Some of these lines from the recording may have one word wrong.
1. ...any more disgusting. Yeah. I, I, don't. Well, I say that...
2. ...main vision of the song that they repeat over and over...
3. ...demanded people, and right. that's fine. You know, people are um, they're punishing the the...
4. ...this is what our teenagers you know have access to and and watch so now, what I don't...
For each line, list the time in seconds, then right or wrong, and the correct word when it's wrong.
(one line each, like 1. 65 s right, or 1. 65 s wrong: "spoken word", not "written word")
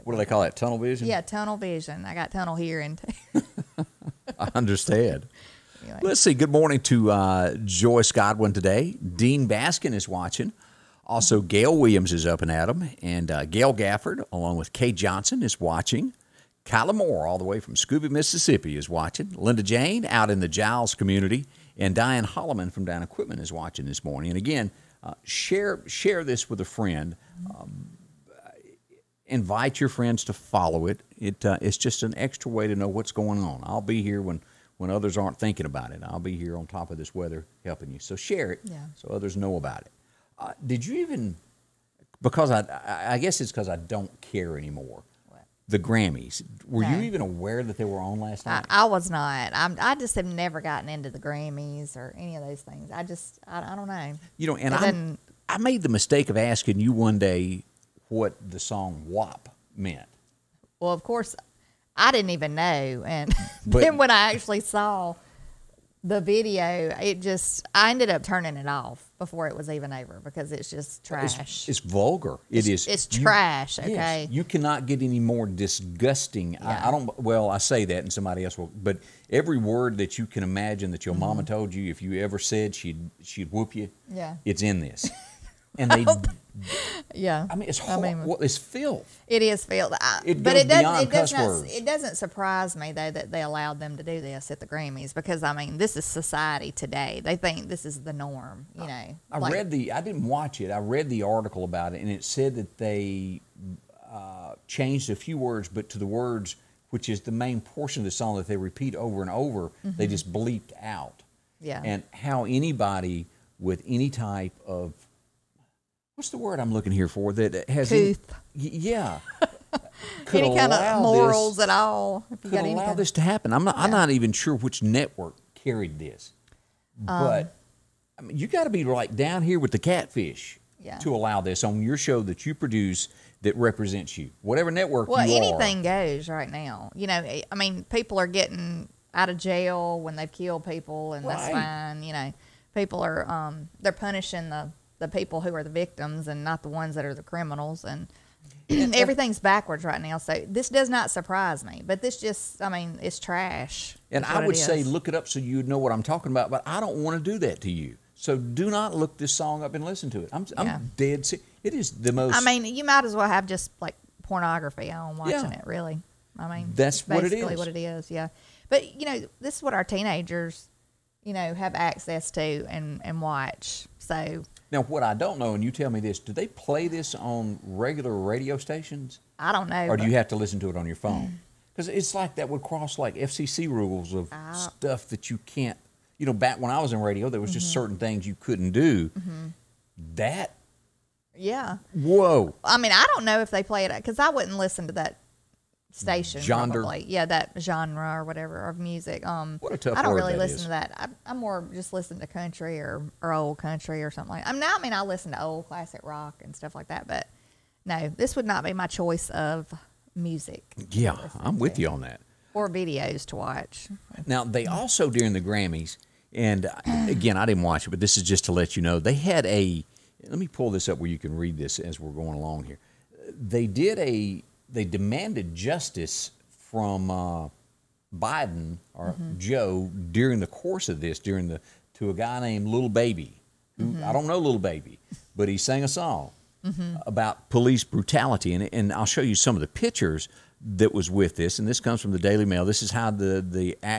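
1. 75 s right
2. 107 s wrong: "portion", not "vision"
3. 140 s wrong: "killed", not "demanded"
4. 169 s right.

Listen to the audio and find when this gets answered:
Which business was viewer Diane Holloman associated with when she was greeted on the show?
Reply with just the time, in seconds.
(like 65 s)
22 s.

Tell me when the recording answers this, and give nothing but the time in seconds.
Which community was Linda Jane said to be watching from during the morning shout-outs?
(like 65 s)
20 s.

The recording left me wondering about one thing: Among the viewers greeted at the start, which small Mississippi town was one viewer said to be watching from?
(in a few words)
Scooba.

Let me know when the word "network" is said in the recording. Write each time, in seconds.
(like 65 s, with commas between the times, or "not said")
124 s, 134 s.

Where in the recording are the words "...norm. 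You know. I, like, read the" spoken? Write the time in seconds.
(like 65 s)
98 s.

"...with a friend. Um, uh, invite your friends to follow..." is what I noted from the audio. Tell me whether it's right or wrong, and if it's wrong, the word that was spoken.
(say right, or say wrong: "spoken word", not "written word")
right.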